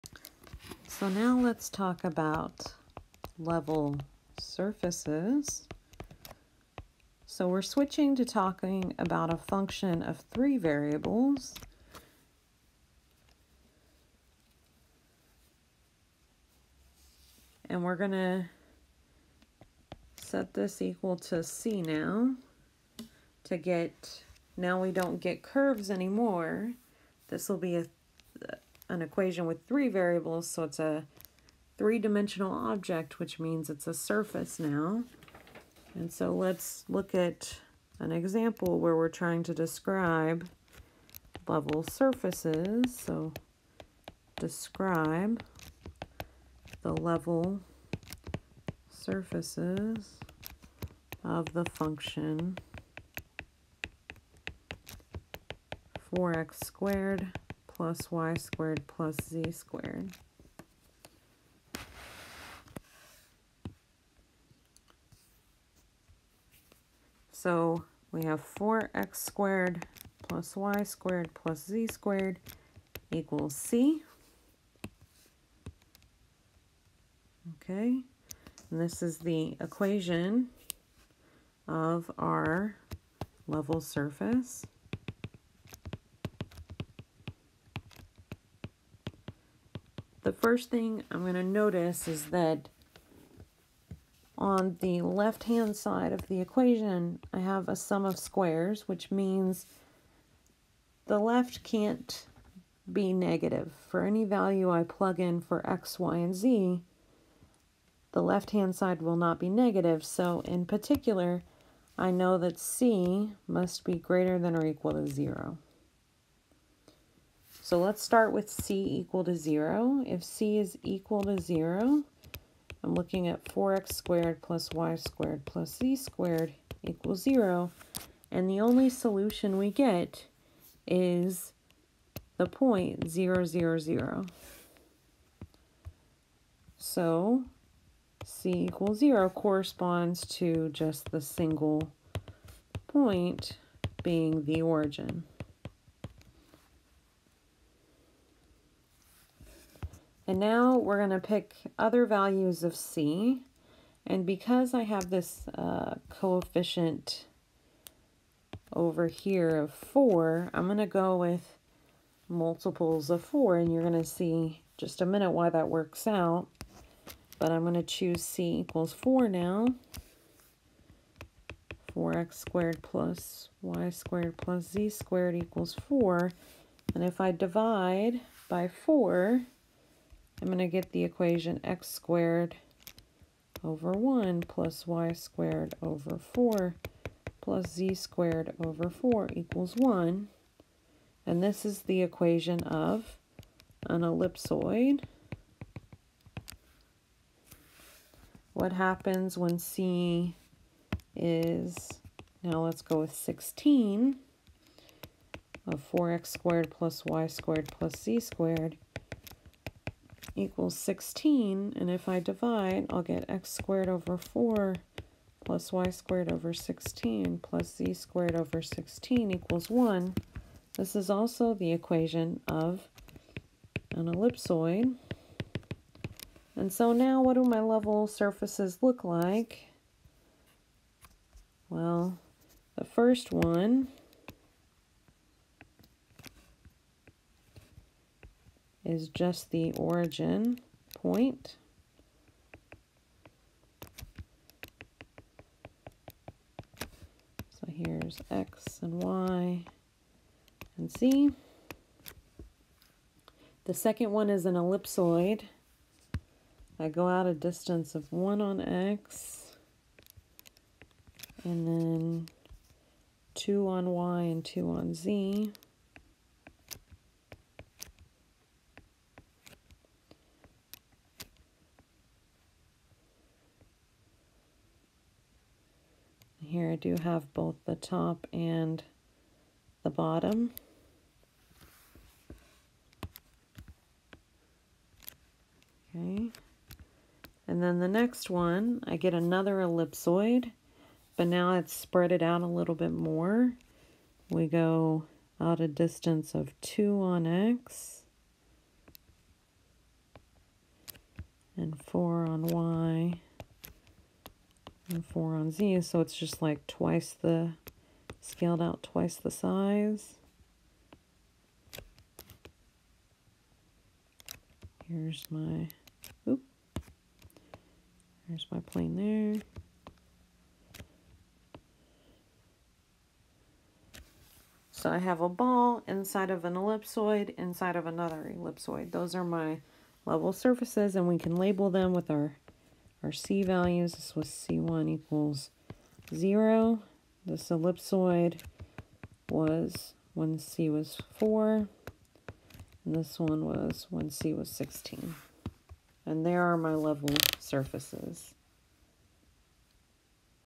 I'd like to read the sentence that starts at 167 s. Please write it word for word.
But I'm going to choose C equals 4 now.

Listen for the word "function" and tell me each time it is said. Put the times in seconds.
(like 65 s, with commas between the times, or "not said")
9 s, 51 s.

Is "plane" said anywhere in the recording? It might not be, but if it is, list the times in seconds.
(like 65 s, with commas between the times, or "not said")
318 s.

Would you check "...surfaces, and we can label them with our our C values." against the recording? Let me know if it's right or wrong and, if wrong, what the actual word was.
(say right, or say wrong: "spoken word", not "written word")
right.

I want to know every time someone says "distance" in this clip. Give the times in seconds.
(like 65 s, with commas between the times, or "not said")
257 s, 295 s.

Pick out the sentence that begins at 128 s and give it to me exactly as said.
And the only solution we get is the point 0, 0, 0.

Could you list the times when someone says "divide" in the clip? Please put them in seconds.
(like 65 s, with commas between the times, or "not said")
177 s, 212 s.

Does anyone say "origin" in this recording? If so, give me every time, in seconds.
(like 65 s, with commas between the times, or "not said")
144 s, 239 s.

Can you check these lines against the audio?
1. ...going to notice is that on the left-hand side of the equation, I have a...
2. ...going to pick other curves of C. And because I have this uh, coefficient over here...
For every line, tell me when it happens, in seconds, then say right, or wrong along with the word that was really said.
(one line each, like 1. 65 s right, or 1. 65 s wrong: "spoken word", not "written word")
1. 91 s right
2. 151 s wrong: "values", not "curves".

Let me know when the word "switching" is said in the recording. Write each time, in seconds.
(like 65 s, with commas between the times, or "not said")
7 s.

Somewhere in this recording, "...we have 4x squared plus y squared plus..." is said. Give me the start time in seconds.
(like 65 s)
68 s.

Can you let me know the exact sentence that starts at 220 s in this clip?
This is also the equation of an ellipsoid.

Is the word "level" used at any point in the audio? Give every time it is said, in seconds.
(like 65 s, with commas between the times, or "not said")
3 s, 41 s, 46 s, 83 s, 227 s, 330 s, 346 s.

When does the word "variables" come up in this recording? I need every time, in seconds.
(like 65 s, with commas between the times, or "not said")
10 s, 29 s.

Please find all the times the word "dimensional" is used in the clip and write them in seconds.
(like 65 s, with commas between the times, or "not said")
31 s.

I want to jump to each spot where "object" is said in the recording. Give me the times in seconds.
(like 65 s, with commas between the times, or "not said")
32 s.